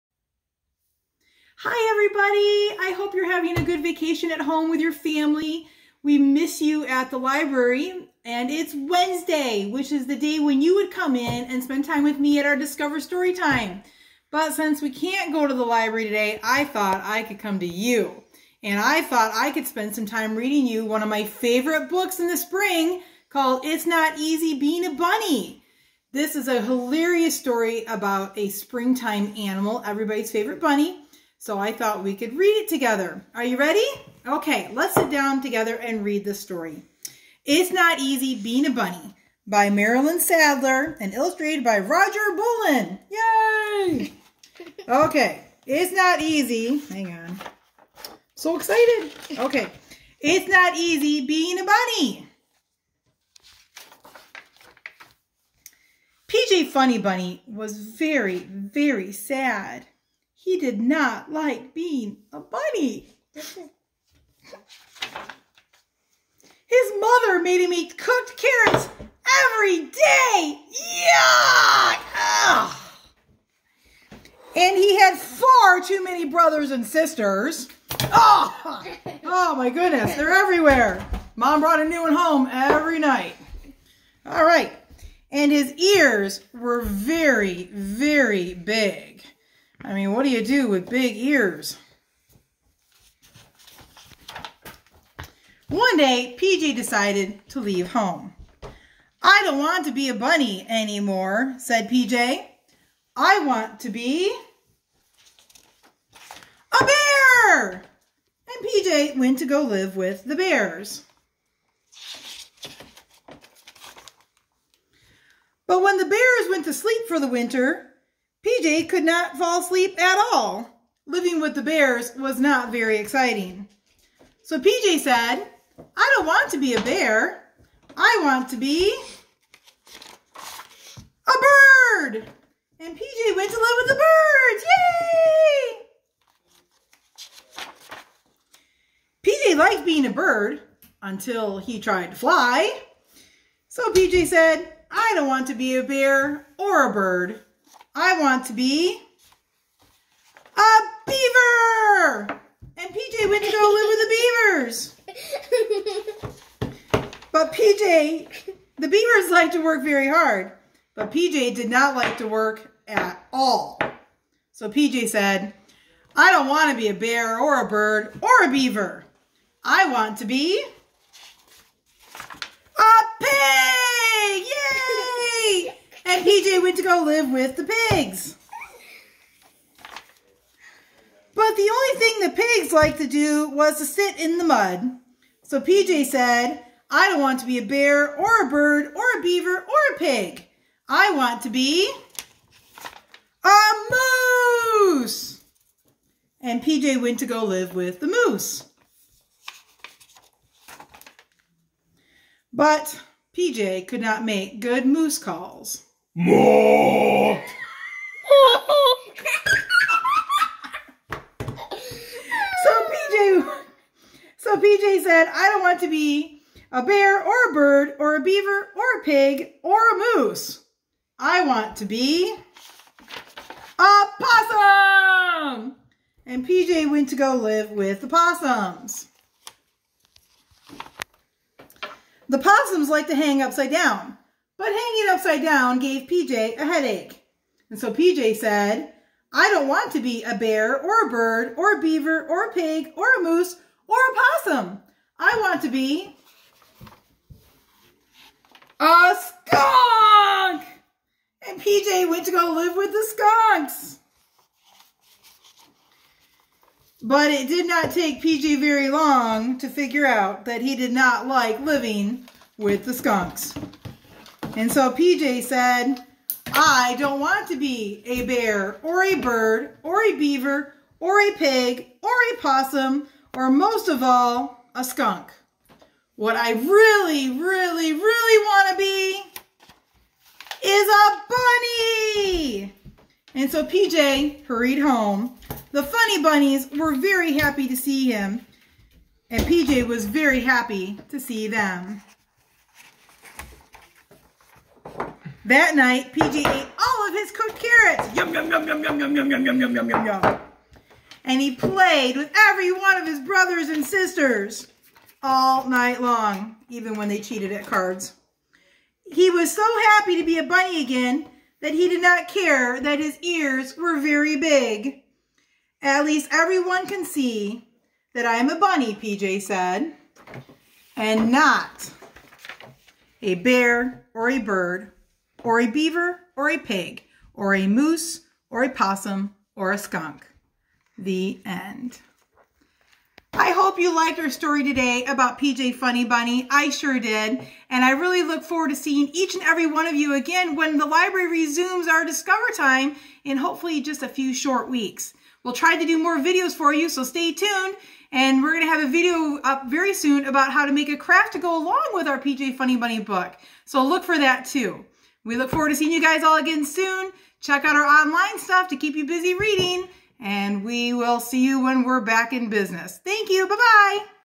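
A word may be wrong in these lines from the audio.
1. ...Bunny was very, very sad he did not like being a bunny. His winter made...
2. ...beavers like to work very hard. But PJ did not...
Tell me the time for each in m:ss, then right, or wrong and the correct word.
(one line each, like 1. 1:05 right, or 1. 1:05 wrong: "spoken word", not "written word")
1. 0:56 wrong: "mother", not "winter"
2. 2:38 right.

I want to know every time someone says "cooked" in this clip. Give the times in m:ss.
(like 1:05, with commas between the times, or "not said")
1:07, 4:57.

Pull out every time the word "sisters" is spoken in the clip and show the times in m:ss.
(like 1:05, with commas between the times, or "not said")
1:16, 5:03.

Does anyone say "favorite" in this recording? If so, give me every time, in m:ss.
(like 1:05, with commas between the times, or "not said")
0:21, 0:30.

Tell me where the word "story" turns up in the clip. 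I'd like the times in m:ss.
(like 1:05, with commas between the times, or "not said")
0:12, 0:27, 0:36, 5:34.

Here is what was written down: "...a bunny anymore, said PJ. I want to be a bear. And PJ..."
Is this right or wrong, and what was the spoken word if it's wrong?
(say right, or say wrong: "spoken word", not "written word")
right.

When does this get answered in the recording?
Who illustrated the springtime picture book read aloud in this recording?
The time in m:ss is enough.
0:41.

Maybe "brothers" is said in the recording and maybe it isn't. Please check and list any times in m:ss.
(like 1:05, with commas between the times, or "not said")
1:16, 5:03.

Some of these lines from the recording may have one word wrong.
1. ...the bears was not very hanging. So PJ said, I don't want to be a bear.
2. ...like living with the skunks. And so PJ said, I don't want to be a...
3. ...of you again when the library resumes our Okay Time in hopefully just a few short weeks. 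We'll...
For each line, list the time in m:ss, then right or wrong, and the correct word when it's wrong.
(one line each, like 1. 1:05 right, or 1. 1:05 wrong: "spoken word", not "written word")
1. 2:01 wrong: "exciting", not "hanging"
2. 4:21 right
3. 5:39 wrong: "Discover", not "Okay".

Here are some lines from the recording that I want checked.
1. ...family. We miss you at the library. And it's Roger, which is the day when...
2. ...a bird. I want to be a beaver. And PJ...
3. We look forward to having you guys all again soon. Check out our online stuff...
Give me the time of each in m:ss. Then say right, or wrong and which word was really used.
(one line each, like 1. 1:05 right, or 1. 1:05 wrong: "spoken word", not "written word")
1. 0:04 wrong: "Wednesday", not "Roger"
2. 2:26 right
3. 5:55 wrong: "seeing", not "having".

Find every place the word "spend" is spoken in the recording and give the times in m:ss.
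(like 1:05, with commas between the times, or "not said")
0:11, 0:19.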